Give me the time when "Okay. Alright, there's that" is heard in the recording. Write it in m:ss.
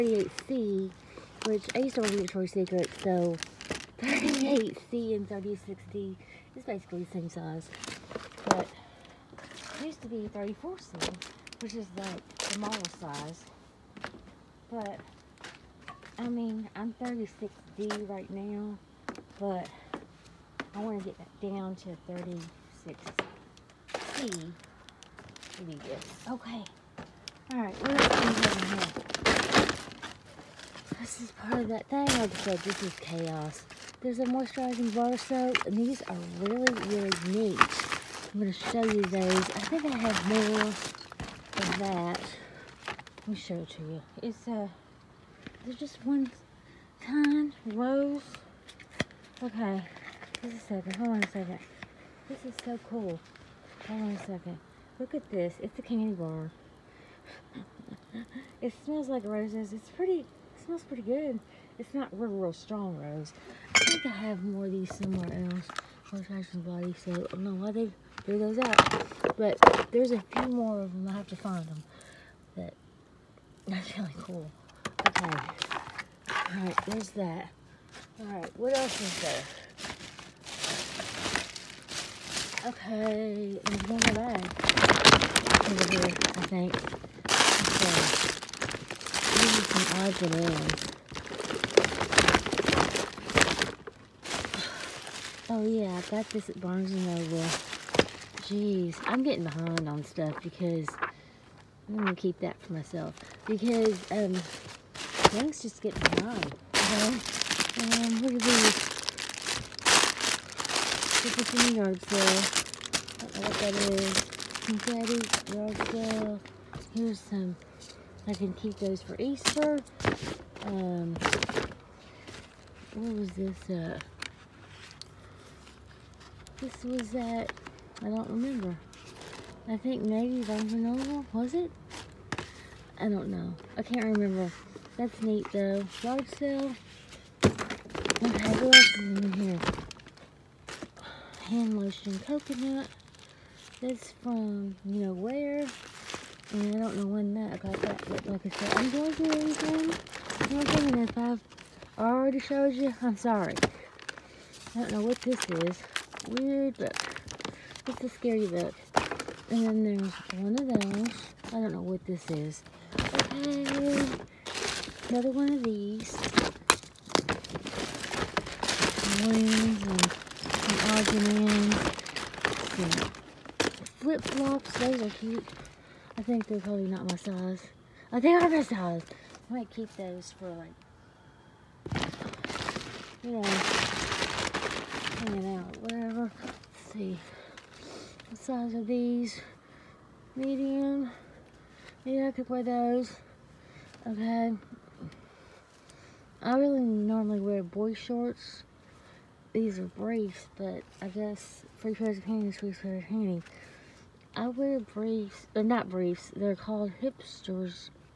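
1:15.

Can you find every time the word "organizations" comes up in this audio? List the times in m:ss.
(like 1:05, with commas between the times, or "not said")
not said.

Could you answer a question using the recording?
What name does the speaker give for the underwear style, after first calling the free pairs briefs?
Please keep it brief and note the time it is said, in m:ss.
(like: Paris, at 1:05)
Hipsters, at 3:27.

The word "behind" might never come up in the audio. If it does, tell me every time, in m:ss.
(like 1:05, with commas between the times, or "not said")
1:39, 1:46.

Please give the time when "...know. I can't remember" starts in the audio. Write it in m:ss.
2:13.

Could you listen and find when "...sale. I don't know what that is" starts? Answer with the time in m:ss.
1:52.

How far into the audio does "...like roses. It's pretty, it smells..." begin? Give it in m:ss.
0:59.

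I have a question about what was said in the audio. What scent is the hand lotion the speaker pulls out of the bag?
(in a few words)
Coconut.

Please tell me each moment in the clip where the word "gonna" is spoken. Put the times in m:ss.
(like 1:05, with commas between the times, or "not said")
1:41.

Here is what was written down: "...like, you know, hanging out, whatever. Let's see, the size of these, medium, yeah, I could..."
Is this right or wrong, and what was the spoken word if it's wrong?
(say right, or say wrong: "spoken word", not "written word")
right.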